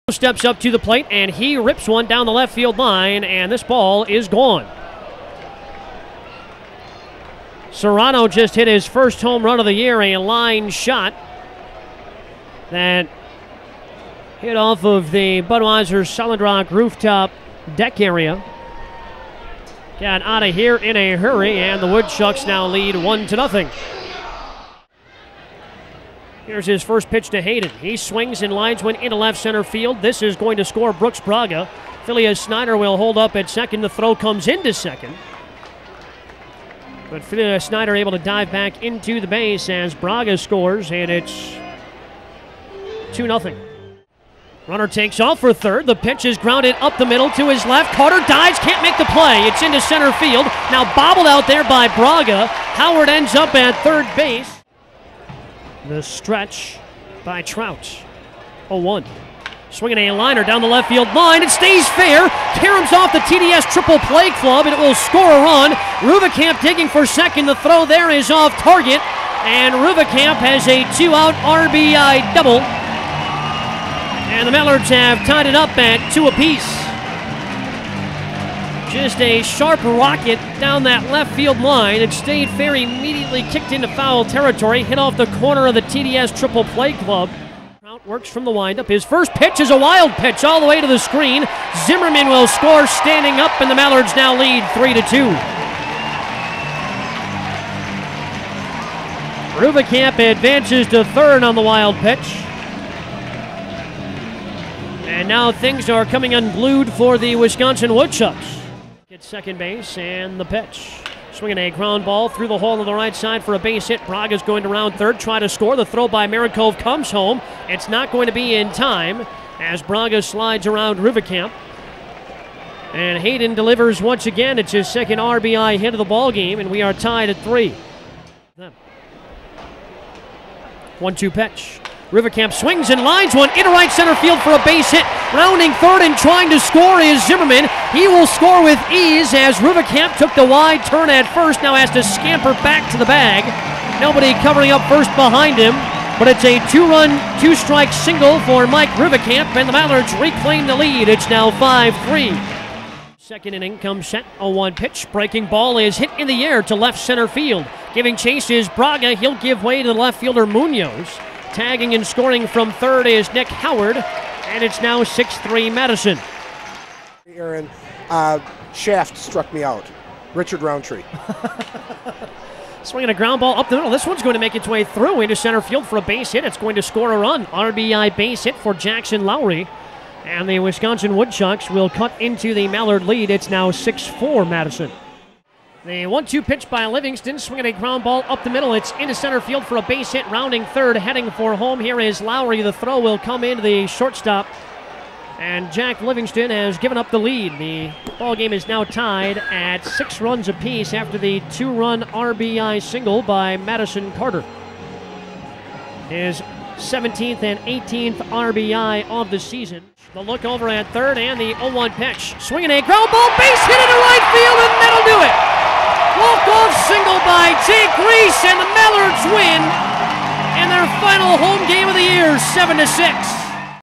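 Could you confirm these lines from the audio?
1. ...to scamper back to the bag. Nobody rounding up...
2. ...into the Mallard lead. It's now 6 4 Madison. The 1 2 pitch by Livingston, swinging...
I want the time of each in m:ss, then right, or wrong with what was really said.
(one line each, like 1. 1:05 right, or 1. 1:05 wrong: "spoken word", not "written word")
1. 2:21 wrong: "covering", not "rounding"
2. 3:02 right.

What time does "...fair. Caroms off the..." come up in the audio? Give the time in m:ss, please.
1:01.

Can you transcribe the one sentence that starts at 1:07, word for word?
The throw there is off target.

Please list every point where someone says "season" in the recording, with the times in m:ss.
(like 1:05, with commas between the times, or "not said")
3:29.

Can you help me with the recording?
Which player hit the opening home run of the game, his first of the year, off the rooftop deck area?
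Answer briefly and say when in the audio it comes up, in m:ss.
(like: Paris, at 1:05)
Serrano, at 0:07.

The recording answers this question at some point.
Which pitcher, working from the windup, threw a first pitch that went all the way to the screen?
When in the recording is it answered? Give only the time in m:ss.
1:27.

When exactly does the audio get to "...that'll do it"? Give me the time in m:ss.
3:34.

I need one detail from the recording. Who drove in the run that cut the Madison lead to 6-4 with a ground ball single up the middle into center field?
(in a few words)
Jackson Lowry.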